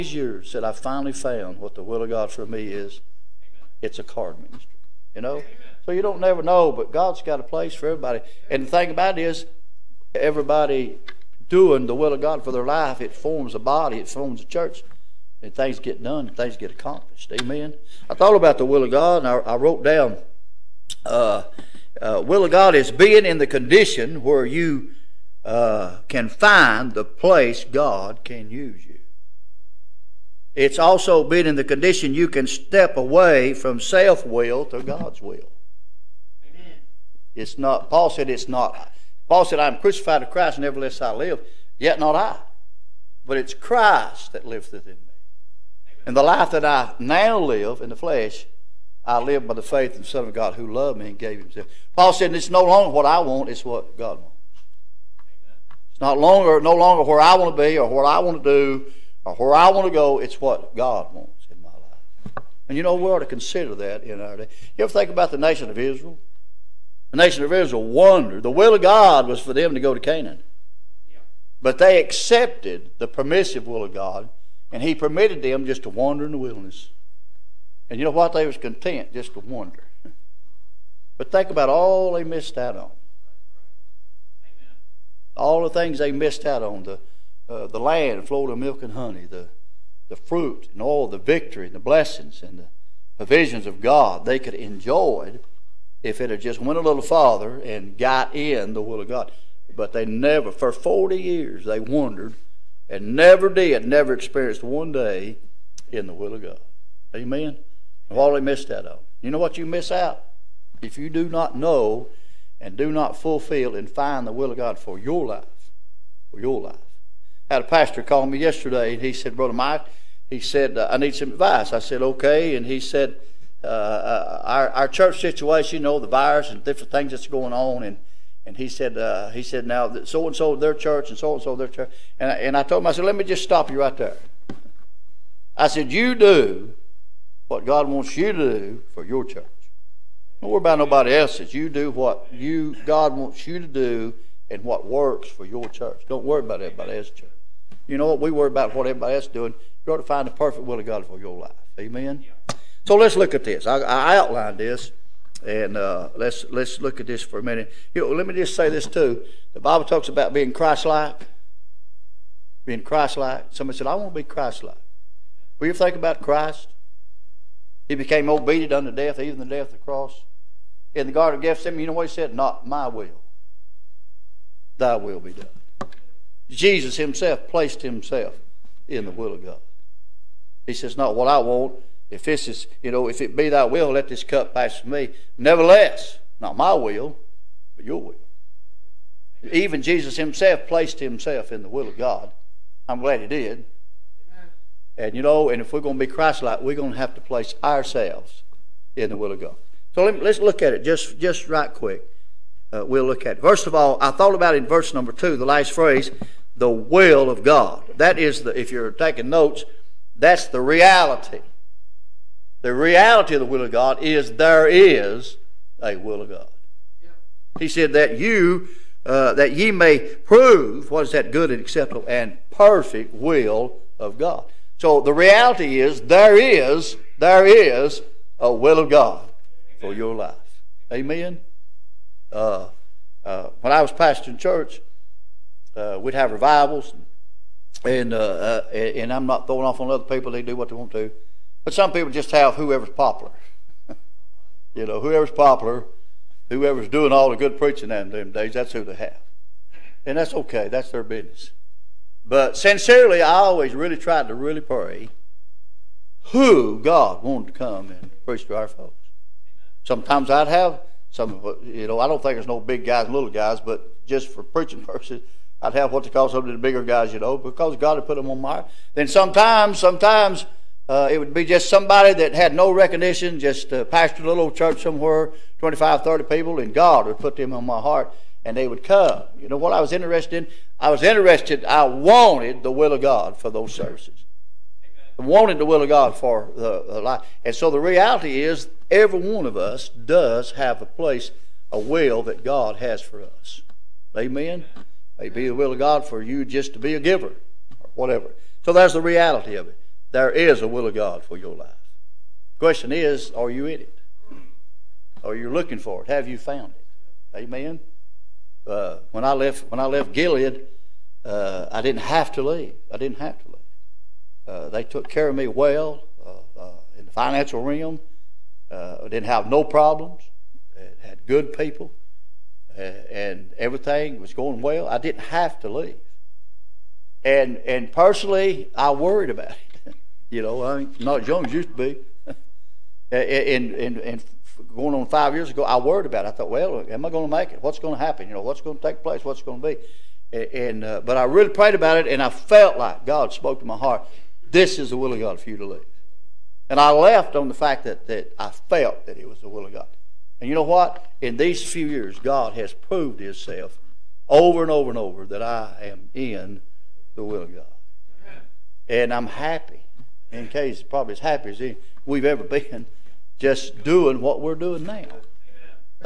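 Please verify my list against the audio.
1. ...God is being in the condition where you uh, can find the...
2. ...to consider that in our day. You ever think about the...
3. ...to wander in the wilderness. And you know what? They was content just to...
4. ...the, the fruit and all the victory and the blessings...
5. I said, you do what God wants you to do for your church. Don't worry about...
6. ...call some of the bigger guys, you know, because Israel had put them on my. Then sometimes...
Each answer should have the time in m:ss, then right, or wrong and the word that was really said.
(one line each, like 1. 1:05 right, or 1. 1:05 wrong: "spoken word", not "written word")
1. 0:22 right
2. 1:03 right
3. 1:15 right
4. 1:29 right
5. 2:15 right
6. 4:26 wrong: "God", not "Israel".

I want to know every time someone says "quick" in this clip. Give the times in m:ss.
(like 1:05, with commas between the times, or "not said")
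3:21.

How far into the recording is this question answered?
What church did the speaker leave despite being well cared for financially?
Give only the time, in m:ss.
5:10.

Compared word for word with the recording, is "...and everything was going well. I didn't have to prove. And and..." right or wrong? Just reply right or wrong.
wrong.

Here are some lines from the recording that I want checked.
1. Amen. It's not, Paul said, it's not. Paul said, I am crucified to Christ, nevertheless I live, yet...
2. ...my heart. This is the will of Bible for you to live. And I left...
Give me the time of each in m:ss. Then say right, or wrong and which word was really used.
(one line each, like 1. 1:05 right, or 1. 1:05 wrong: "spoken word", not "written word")
1. 0:36 right
2. 5:43 wrong: "God", not "Bible".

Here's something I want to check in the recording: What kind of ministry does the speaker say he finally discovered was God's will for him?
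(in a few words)
Card ministry.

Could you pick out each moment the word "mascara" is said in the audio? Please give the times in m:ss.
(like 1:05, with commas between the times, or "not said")
not said.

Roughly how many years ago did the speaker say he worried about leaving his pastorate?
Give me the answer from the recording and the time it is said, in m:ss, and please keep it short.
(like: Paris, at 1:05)
5, at 5:35.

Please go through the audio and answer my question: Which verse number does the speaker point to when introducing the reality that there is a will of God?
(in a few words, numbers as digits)
2.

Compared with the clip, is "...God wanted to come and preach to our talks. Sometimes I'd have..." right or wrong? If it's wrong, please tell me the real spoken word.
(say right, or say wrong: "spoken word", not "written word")
wrong: "folks", not "talks".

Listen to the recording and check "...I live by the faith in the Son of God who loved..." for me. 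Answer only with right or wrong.
right.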